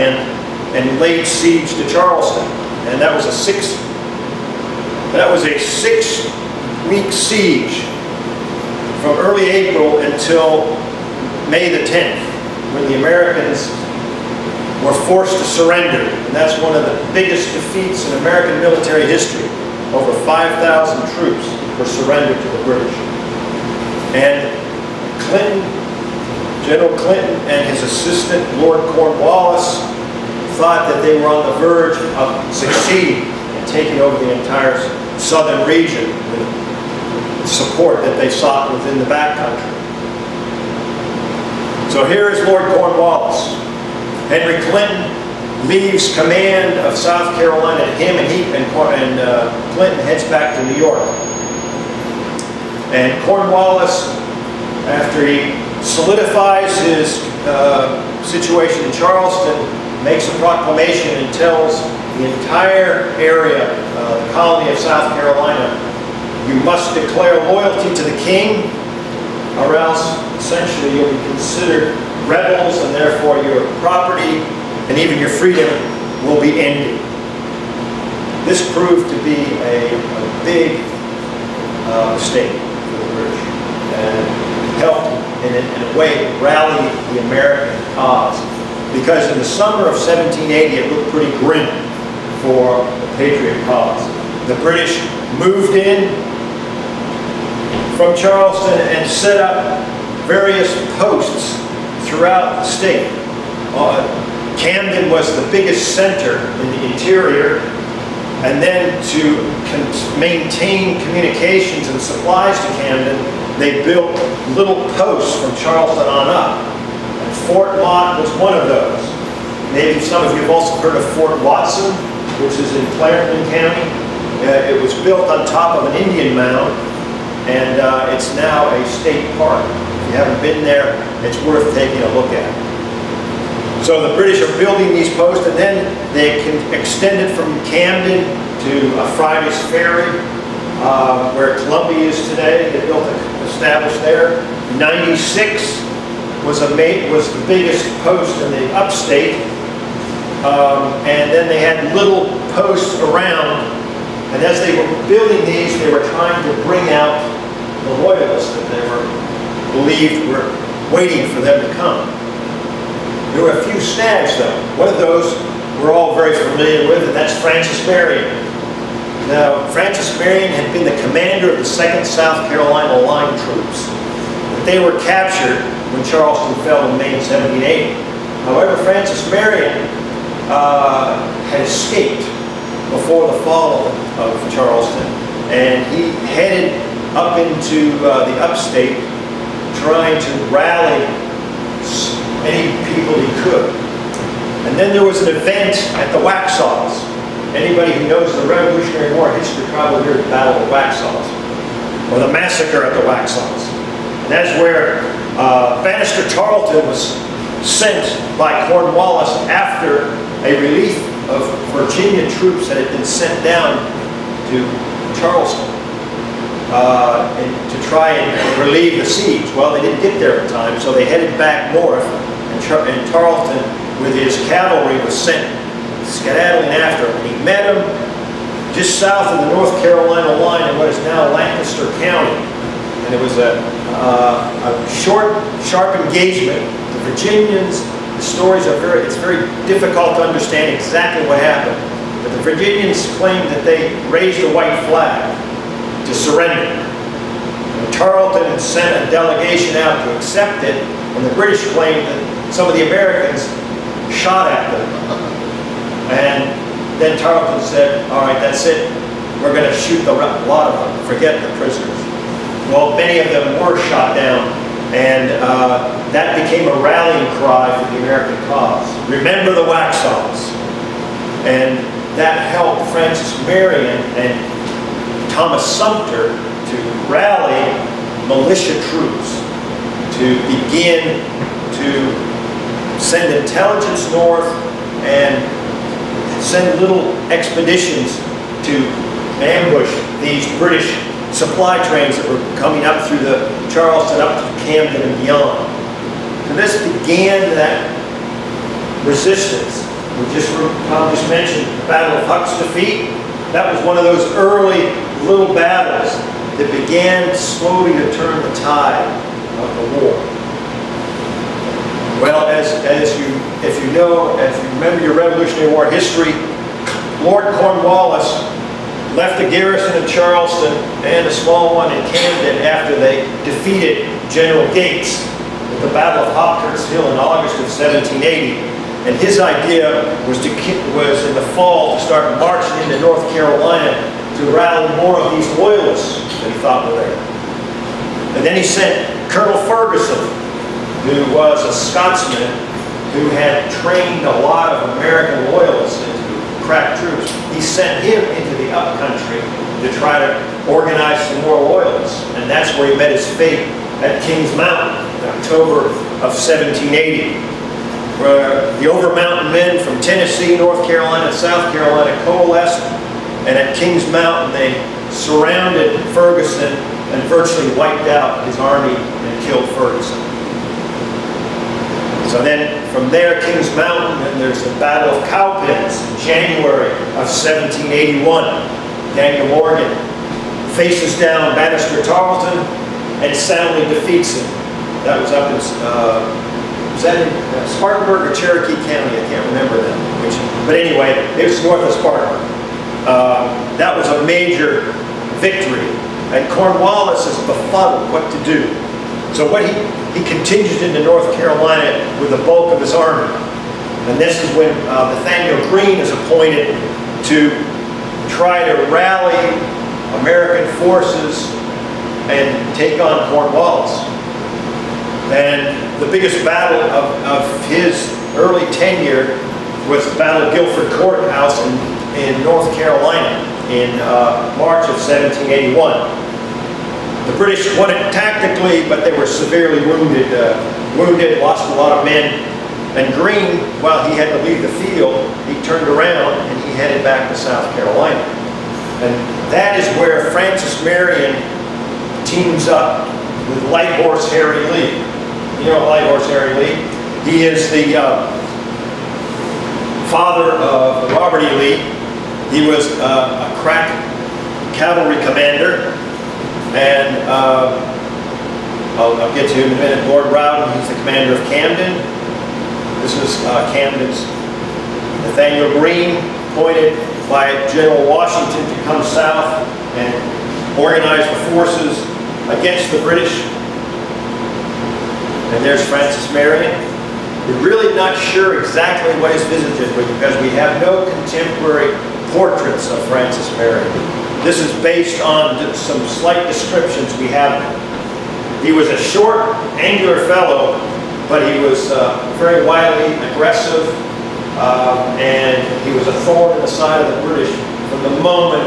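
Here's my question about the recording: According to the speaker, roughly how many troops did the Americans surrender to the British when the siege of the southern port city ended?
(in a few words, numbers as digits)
Over 5,000.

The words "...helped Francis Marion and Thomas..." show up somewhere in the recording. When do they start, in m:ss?
4:32.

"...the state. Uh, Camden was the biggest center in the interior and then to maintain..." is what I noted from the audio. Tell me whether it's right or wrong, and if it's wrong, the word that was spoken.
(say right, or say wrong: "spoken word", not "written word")
right.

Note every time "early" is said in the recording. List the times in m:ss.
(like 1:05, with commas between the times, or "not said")
0:09, 5:04, 6:58.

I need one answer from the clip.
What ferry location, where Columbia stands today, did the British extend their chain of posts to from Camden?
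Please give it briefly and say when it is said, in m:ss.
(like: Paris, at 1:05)
Fridays Ferry, at 2:19.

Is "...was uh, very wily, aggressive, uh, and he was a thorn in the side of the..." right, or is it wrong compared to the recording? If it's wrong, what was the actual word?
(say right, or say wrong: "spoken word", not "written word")
right.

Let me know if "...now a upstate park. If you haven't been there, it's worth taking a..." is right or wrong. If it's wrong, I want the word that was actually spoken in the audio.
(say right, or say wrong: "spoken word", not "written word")
wrong: "state", not "upstate".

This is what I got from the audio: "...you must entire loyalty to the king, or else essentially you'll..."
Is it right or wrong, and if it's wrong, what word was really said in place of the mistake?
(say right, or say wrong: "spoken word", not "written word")
wrong: "declare", not "entire".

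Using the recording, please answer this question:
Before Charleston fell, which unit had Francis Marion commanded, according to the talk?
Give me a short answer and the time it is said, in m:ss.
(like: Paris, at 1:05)
2nd South Carolina Line, at 2:51.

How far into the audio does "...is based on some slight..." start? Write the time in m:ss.
8:04.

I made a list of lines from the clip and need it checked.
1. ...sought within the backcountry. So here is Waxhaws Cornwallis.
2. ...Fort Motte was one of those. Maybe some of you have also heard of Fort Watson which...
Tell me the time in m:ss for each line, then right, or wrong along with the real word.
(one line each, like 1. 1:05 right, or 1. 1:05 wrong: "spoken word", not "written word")
1. 0:38 wrong: "Lord", not "Waxhaws"
2. 1:57 right.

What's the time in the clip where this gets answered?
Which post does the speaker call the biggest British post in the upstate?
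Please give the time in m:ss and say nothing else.
2:24.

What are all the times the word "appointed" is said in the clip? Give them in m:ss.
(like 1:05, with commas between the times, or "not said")
6:46, 7:46.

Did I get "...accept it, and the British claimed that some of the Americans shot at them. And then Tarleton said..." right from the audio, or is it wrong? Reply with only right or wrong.
right.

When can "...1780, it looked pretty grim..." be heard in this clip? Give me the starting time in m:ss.
1:29.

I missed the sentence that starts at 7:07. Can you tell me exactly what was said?
The British won it tactically, but they were severely wounded, uh, wounded, lost a lot of men.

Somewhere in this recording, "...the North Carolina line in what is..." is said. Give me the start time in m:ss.
3:49.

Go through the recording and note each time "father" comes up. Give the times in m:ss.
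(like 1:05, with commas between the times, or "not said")
7:30.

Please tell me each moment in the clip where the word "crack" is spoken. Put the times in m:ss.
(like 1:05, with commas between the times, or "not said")
5:46, 7:33.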